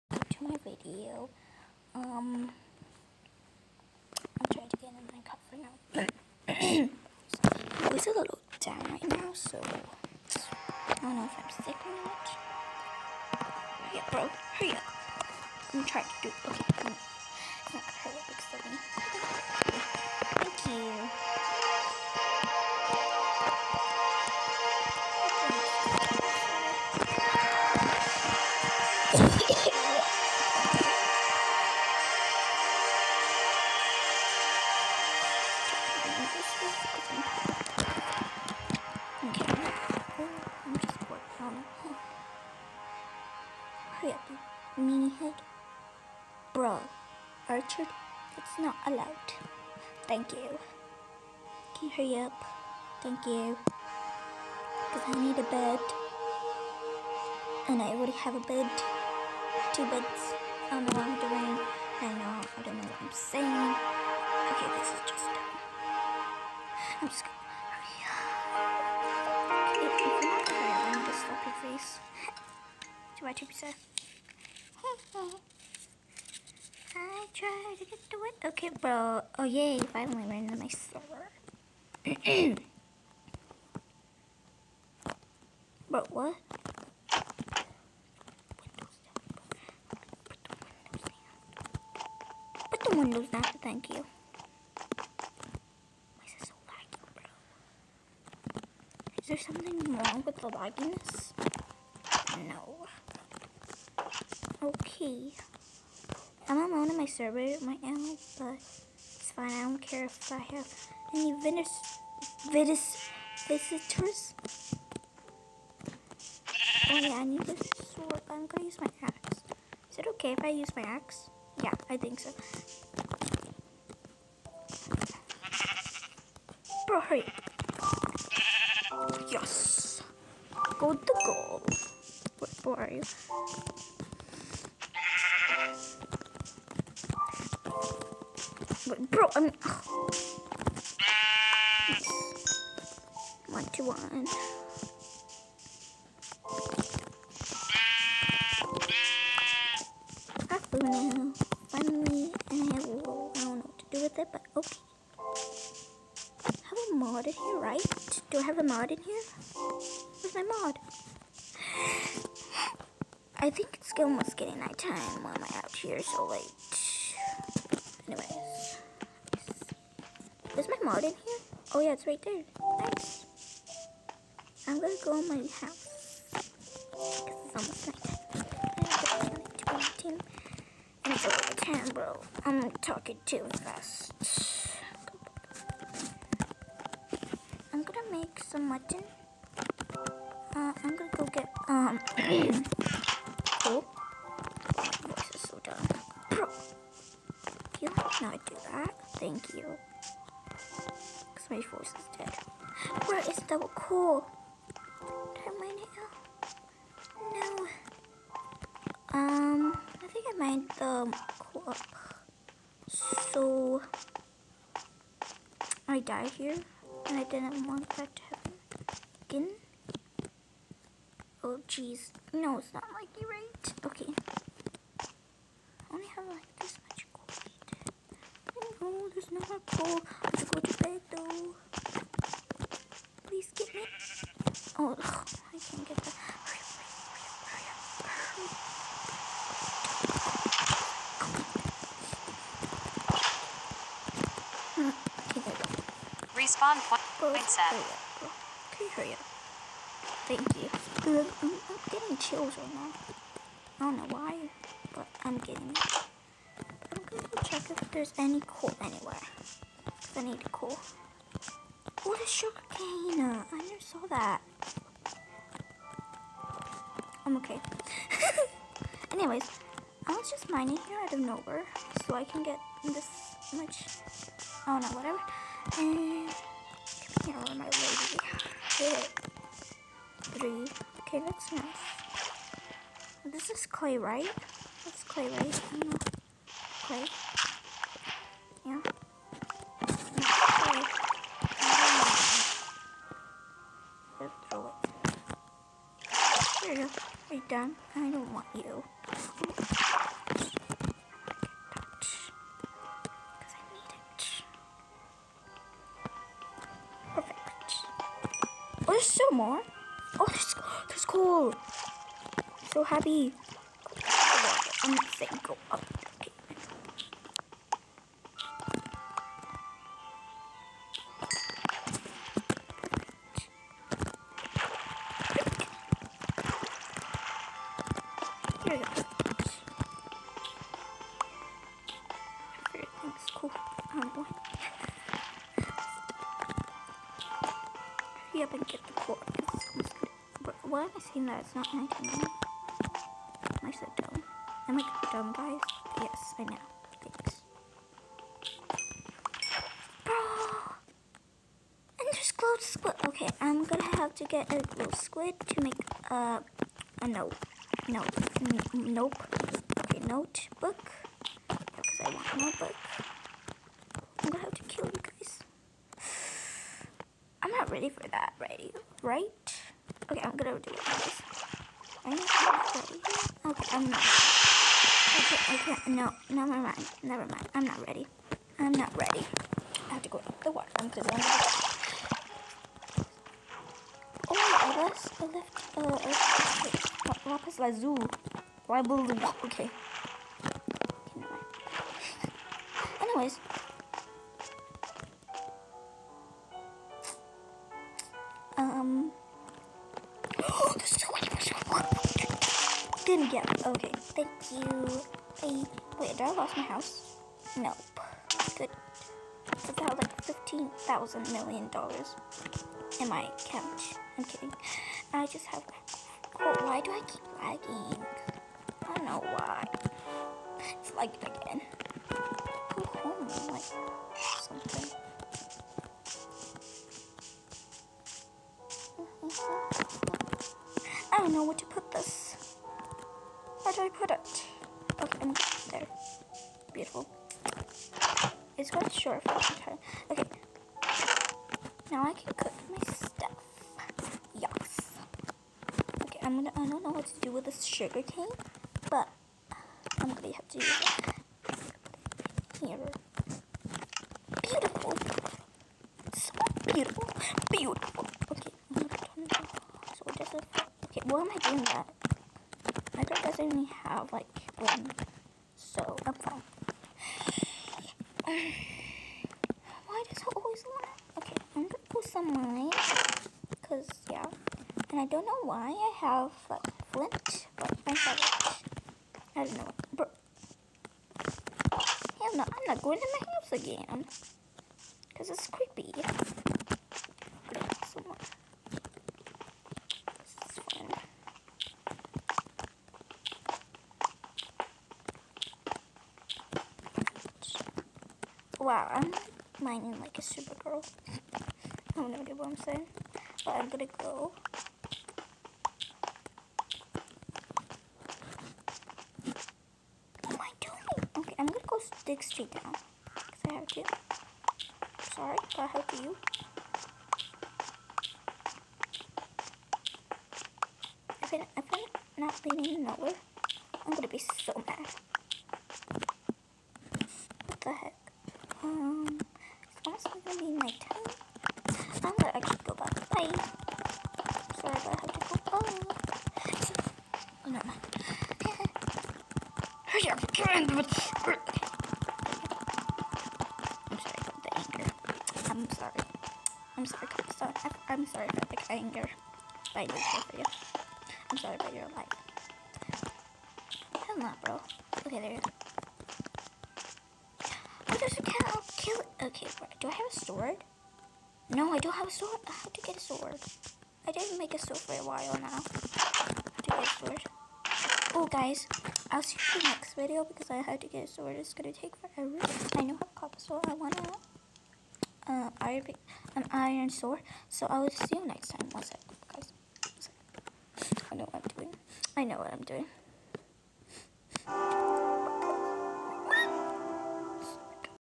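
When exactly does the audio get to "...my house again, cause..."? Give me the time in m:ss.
8:03.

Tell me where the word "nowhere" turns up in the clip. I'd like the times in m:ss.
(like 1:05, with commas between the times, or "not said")
4:31, 8:42.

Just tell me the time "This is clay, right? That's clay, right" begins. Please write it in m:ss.
4:43.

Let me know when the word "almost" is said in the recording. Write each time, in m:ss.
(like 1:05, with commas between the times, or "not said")
2:43, 2:57.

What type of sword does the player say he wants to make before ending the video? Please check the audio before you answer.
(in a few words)
iron sword.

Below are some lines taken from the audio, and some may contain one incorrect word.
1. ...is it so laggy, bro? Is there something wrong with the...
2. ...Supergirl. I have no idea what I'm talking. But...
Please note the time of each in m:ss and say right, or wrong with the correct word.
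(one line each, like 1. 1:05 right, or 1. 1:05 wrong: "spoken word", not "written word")
1. 1:36 right
2. 8:20 wrong: "saying", not "talking".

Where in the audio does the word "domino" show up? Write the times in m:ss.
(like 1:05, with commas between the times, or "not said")
not said.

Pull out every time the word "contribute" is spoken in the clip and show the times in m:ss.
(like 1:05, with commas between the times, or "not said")
not said.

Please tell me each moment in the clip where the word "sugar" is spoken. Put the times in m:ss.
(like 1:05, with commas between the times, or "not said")
4:22, 7:27.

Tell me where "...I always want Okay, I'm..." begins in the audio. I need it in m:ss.
7:50.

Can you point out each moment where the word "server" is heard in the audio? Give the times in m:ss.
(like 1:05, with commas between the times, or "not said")
1:20, 1:47.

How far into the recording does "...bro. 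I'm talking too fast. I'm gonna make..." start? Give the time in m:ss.
3:01.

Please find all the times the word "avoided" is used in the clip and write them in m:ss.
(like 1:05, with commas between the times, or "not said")
not said.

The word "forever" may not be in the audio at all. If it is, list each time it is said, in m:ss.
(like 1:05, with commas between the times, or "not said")
9:31.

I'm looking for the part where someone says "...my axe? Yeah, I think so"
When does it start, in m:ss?
2:00.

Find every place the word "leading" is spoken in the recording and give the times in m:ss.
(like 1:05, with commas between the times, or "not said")
8:42.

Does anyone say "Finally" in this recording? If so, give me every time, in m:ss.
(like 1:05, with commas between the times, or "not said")
1:19, 2:27.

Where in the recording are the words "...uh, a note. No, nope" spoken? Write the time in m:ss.
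5:56.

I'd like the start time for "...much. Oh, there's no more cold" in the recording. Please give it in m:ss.
3:46.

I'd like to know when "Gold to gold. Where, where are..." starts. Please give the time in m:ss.
2:10.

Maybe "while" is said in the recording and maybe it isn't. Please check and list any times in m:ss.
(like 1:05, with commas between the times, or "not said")
9:25.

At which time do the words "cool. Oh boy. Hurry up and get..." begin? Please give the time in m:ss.
5:33.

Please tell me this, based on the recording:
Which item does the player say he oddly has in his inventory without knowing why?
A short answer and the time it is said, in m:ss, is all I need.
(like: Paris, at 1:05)
flint, at 7:56.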